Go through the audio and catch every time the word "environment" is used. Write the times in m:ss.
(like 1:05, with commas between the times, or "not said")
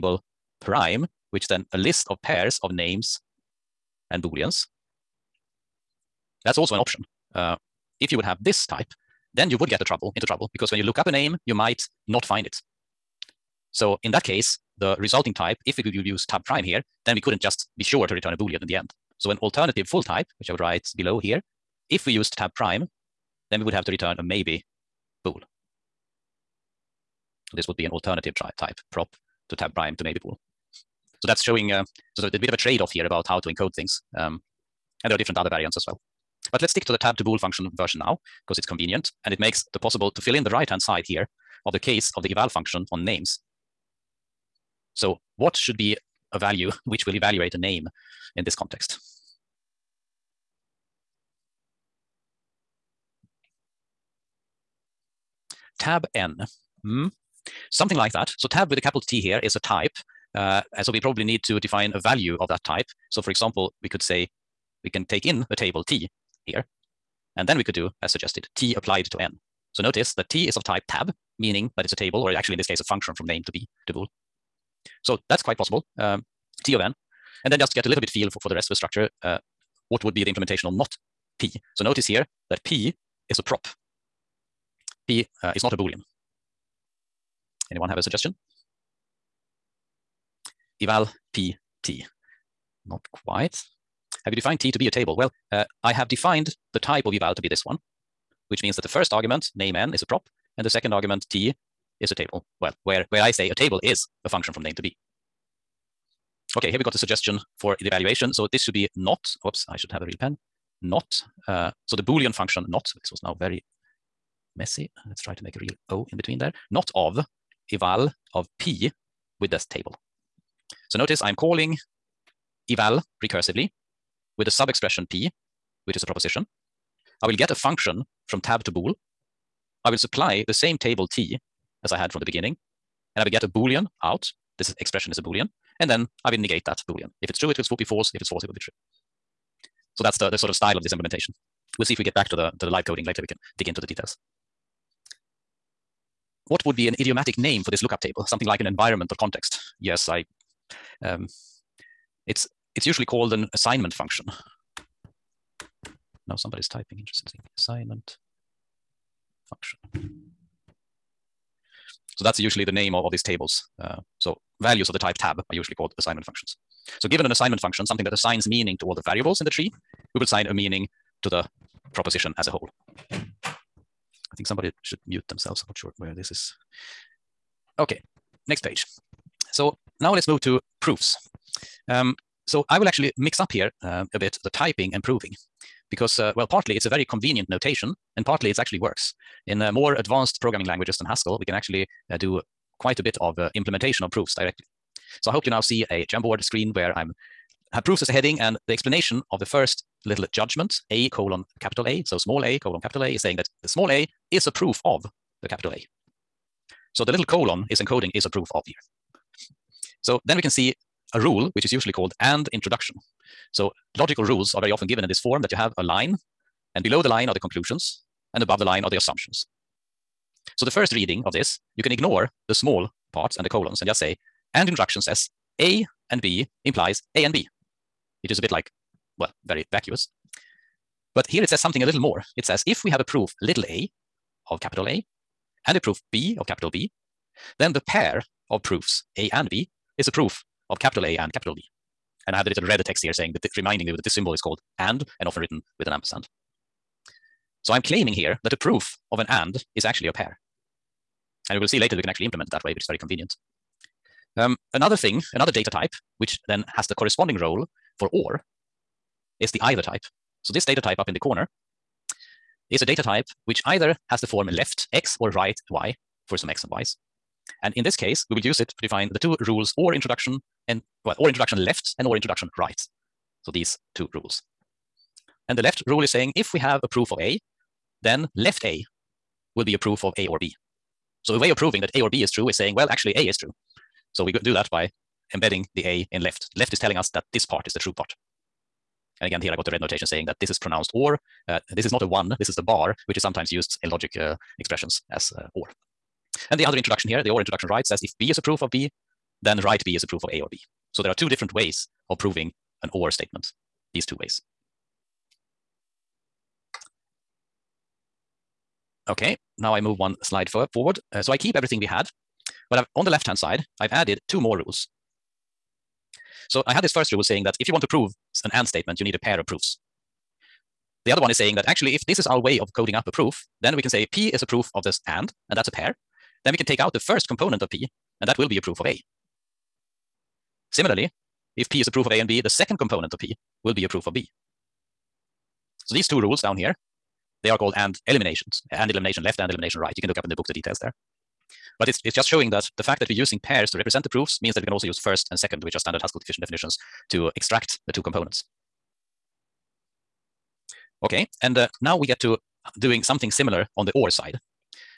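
2:28.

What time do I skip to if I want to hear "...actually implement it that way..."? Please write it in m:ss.
4:12.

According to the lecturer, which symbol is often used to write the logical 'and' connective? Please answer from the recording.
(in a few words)
Ampersand.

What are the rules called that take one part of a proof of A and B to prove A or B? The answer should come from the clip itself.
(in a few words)
And eliminations.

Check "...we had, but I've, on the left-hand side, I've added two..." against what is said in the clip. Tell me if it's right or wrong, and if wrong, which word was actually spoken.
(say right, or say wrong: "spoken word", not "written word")
right.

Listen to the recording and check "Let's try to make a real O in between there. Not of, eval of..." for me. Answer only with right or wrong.
right.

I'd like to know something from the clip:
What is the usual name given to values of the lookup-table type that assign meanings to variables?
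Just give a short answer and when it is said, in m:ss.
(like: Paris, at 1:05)
Assignment functions, at 2:45.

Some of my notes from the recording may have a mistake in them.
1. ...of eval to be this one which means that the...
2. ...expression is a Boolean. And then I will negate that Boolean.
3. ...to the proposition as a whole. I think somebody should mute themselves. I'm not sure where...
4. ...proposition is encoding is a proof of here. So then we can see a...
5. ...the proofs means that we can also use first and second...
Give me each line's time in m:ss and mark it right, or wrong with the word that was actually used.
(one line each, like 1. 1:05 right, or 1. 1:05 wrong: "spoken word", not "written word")
1. 1:37 right
2. 2:14 right
3. 2:51 right
4. 3:27 wrong: "colon", not "proposition"
5. 5:44 right.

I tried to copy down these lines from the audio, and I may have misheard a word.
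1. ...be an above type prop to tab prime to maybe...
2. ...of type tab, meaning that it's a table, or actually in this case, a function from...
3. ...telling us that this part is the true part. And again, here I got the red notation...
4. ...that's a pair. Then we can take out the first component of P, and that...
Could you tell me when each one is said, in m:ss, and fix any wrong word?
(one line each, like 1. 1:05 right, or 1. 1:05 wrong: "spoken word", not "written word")
1. 0:27 wrong: "alternative", not "above"
2. 1:10 right
3. 4:46 right
4. 5:25 right.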